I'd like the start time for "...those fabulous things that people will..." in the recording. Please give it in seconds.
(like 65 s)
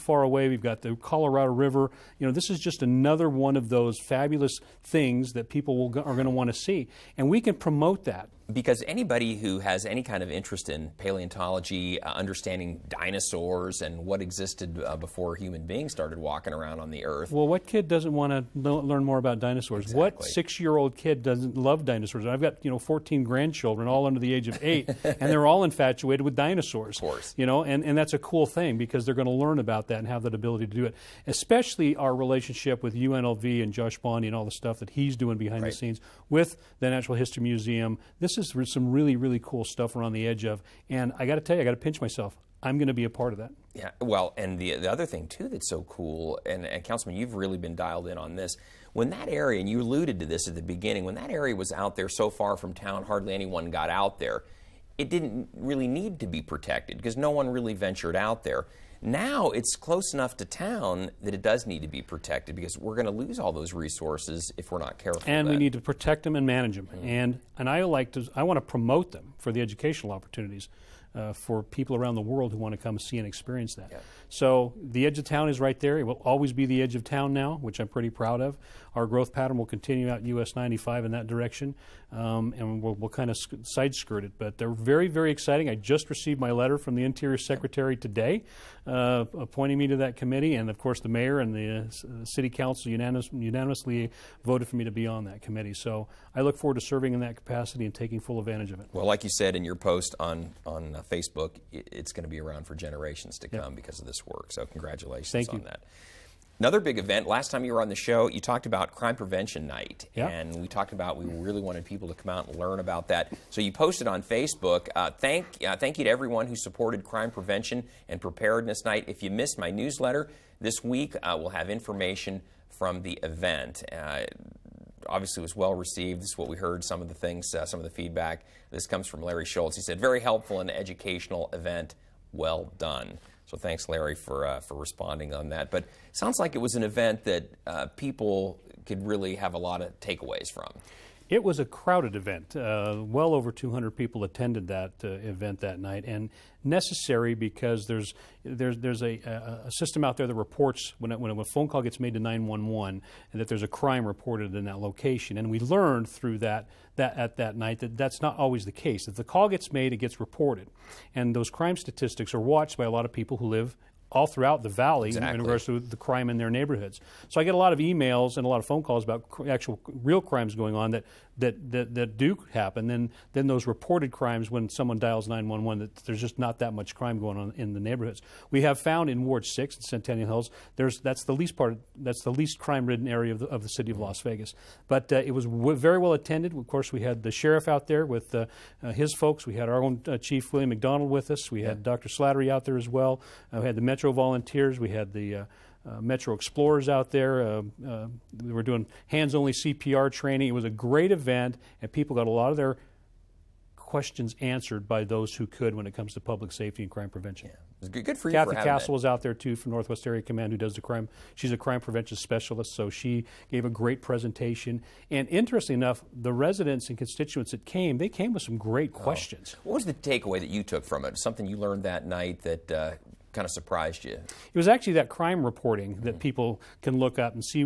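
3 s.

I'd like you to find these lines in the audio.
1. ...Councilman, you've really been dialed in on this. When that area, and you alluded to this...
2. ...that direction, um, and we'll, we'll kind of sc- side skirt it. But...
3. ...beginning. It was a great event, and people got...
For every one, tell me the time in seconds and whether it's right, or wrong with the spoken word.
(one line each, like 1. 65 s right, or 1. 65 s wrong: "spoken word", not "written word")
1. 46 s right
2. 81 s right
3. 200 s wrong: "training", not "beginning".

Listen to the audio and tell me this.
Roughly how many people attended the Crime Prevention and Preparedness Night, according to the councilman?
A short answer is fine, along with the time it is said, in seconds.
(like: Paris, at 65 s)
over 200, at 143 s.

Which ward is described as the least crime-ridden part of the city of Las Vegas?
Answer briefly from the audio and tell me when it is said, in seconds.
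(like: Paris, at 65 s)
Ward 6, at 179 s.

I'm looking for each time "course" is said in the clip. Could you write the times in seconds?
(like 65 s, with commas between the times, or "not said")
27 s, 90 s, 186 s.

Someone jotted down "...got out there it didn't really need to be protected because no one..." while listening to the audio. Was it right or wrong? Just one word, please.
right.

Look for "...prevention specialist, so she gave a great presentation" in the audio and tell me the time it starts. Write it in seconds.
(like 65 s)
211 s.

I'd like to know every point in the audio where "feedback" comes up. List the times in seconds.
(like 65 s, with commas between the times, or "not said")
127 s.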